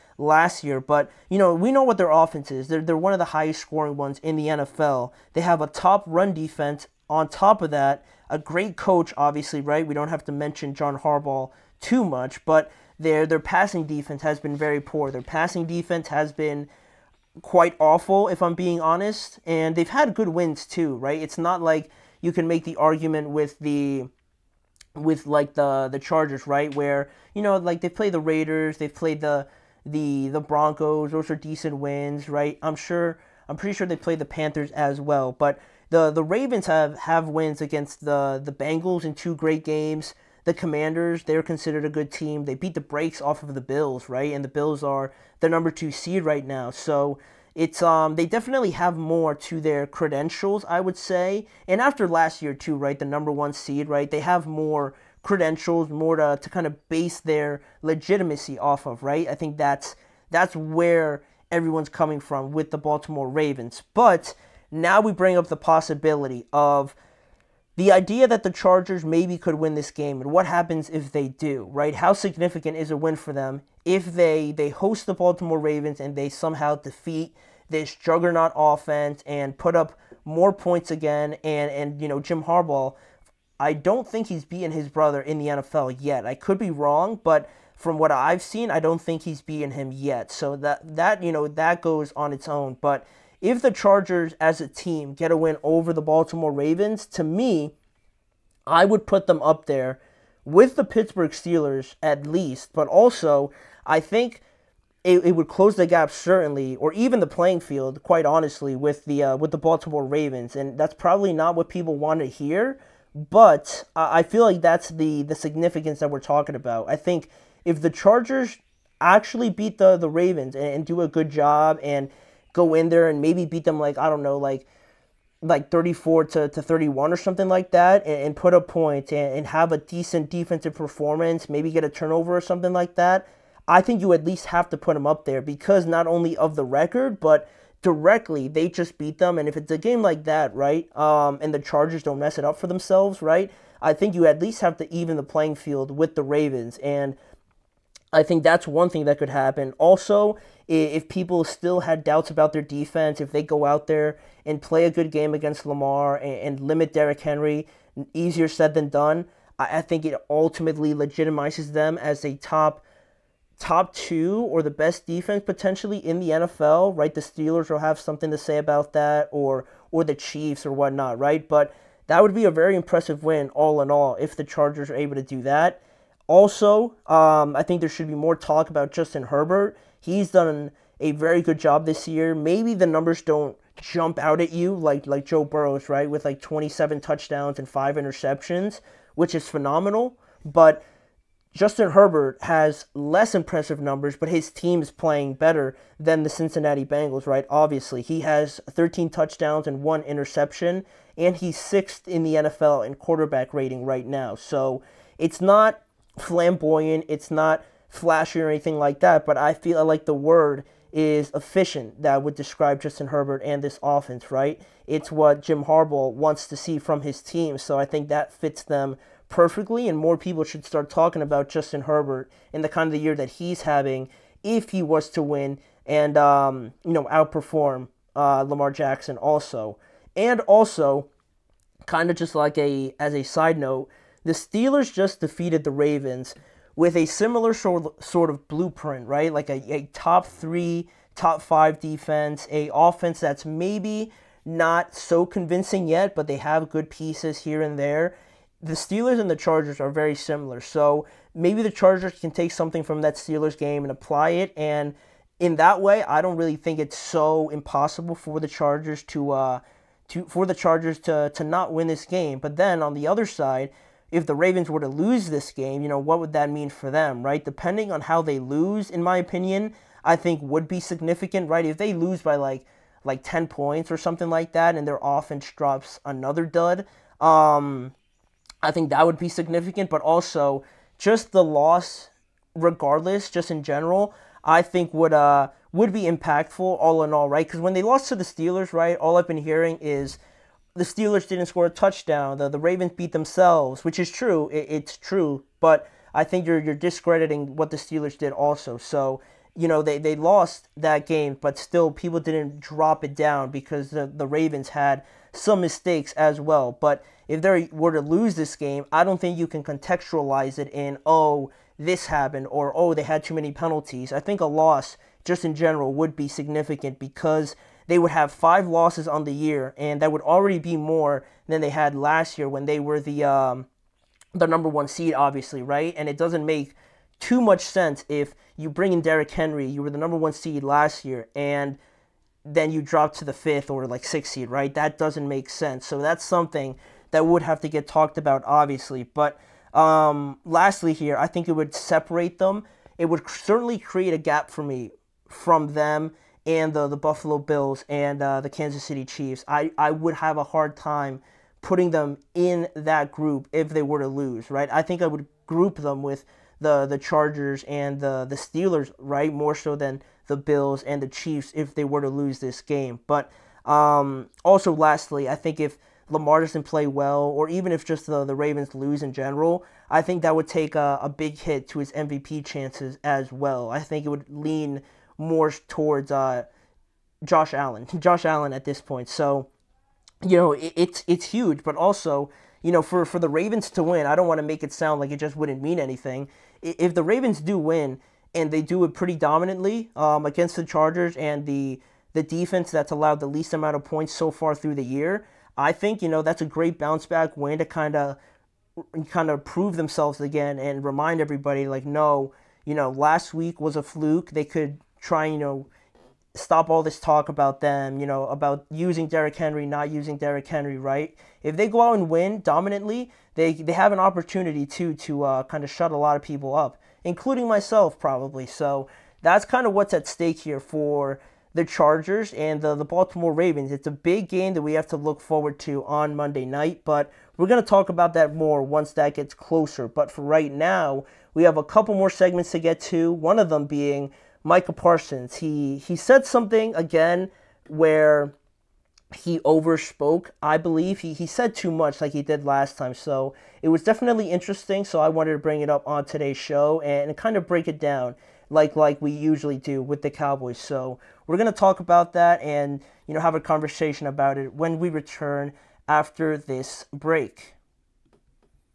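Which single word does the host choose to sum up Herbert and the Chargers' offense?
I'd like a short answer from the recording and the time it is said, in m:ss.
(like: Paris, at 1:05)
efficient, at 3:31.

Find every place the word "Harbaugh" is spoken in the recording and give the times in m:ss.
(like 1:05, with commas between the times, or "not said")
0:10, 1:22, 3:35.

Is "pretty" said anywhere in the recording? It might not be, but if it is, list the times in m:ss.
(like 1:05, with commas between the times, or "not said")
0:33, 6:28.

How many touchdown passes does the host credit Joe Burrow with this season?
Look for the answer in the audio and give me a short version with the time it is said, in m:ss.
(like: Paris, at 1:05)
27, at 3:06.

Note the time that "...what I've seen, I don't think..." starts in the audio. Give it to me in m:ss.
1:27.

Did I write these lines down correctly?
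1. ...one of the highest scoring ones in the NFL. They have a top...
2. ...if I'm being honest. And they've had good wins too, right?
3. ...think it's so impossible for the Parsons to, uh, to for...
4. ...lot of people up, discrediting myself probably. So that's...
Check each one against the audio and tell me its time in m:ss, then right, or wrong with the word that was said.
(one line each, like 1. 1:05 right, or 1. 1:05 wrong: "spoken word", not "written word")
1. 0:02 right
2. 0:18 right
3. 4:16 wrong: "Chargers", not "Parsons"
4. 6:55 wrong: "including", not "discrediting".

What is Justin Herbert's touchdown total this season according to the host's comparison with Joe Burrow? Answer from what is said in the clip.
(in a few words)
13.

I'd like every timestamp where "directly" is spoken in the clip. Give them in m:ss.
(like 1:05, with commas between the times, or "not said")
2:17.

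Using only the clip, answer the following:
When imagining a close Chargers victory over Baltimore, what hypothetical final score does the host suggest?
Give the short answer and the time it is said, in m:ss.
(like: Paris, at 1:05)
34 to 31, at 2:05.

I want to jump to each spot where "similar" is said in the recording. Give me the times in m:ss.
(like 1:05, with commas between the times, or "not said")
3:57, 4:10.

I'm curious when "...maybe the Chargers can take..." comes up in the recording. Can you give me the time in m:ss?
4:11.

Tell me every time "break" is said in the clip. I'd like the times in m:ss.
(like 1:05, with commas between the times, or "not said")
7:27, 7:36.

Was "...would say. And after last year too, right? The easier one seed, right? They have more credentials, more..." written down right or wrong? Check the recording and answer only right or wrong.
wrong.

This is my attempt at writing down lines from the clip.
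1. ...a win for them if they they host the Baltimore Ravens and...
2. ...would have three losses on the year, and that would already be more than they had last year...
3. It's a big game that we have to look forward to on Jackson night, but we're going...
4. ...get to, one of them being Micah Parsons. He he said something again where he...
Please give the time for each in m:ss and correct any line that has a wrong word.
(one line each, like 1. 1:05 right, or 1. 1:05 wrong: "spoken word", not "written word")
1. 1:12 right
2. 5:17 wrong: "five", not "three"
3. 7:03 wrong: "Monday", not "Jackson"
4. 7:12 right.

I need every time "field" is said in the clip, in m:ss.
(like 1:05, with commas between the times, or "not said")
1:47, 2:25.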